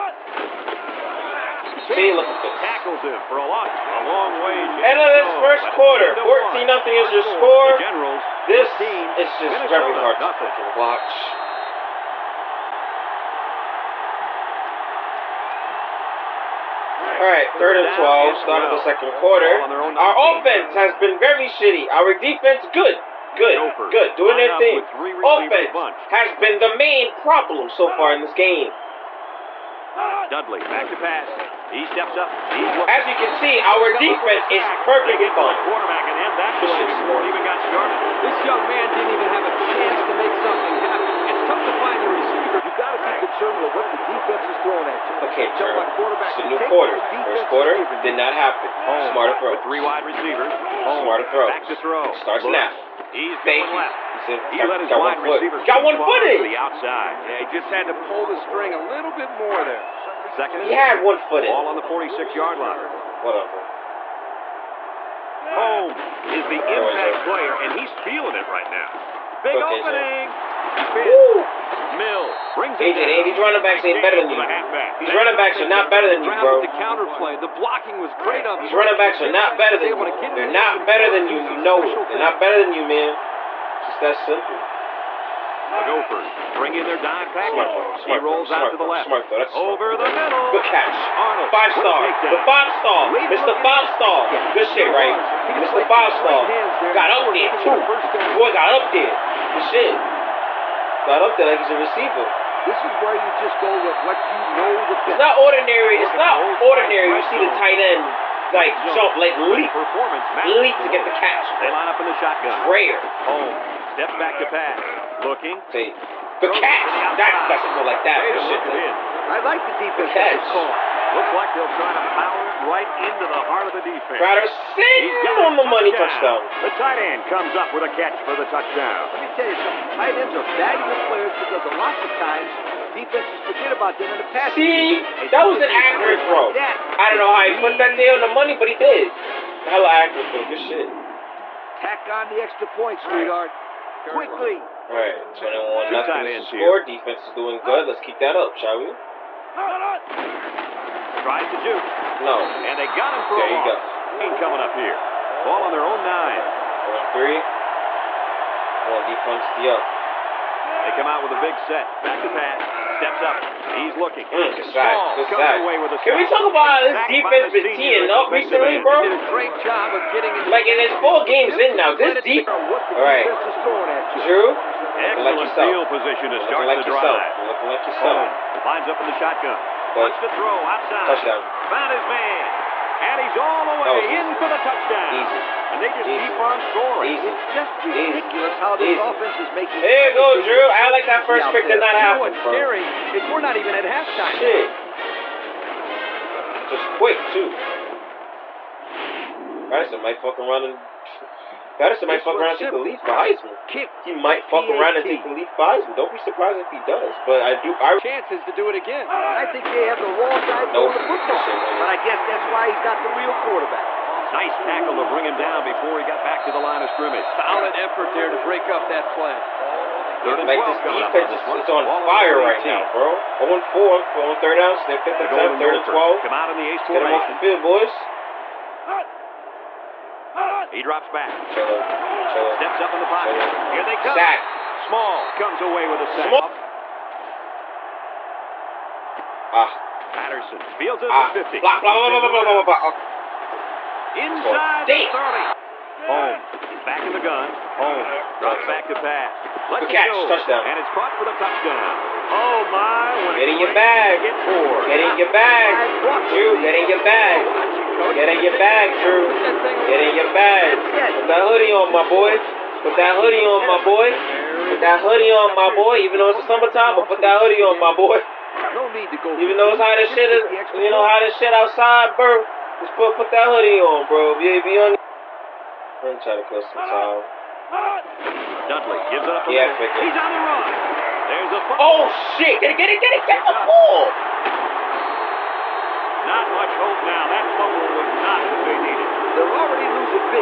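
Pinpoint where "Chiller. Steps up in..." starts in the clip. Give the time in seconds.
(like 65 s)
232 s.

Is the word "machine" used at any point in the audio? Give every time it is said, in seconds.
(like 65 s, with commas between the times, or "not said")
not said.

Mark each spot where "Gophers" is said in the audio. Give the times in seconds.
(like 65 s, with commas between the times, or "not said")
23 s, 85 s.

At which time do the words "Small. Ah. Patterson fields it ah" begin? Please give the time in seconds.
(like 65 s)
236 s.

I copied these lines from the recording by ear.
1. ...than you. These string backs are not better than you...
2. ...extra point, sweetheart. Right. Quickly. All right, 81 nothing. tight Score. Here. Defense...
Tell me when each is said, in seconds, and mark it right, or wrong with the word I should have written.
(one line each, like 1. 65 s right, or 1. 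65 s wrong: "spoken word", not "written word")
1. 74 s wrong: "running", not "string"
2. 142 s wrong: "21", not "81".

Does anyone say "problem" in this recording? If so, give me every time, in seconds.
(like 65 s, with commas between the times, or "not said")
27 s.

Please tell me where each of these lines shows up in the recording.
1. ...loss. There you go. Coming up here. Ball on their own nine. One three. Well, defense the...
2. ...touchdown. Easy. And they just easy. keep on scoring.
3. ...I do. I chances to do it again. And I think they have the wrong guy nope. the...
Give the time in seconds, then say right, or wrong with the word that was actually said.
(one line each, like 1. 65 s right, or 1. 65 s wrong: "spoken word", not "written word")
1. 153 s right
2. 184 s right
3. 207 s right.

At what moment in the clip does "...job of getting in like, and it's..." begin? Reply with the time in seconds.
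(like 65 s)
169 s.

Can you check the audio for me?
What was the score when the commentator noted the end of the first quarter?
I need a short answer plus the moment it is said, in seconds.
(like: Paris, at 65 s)
14-0, at 6 s.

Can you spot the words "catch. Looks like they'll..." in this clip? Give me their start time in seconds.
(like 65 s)
120 s.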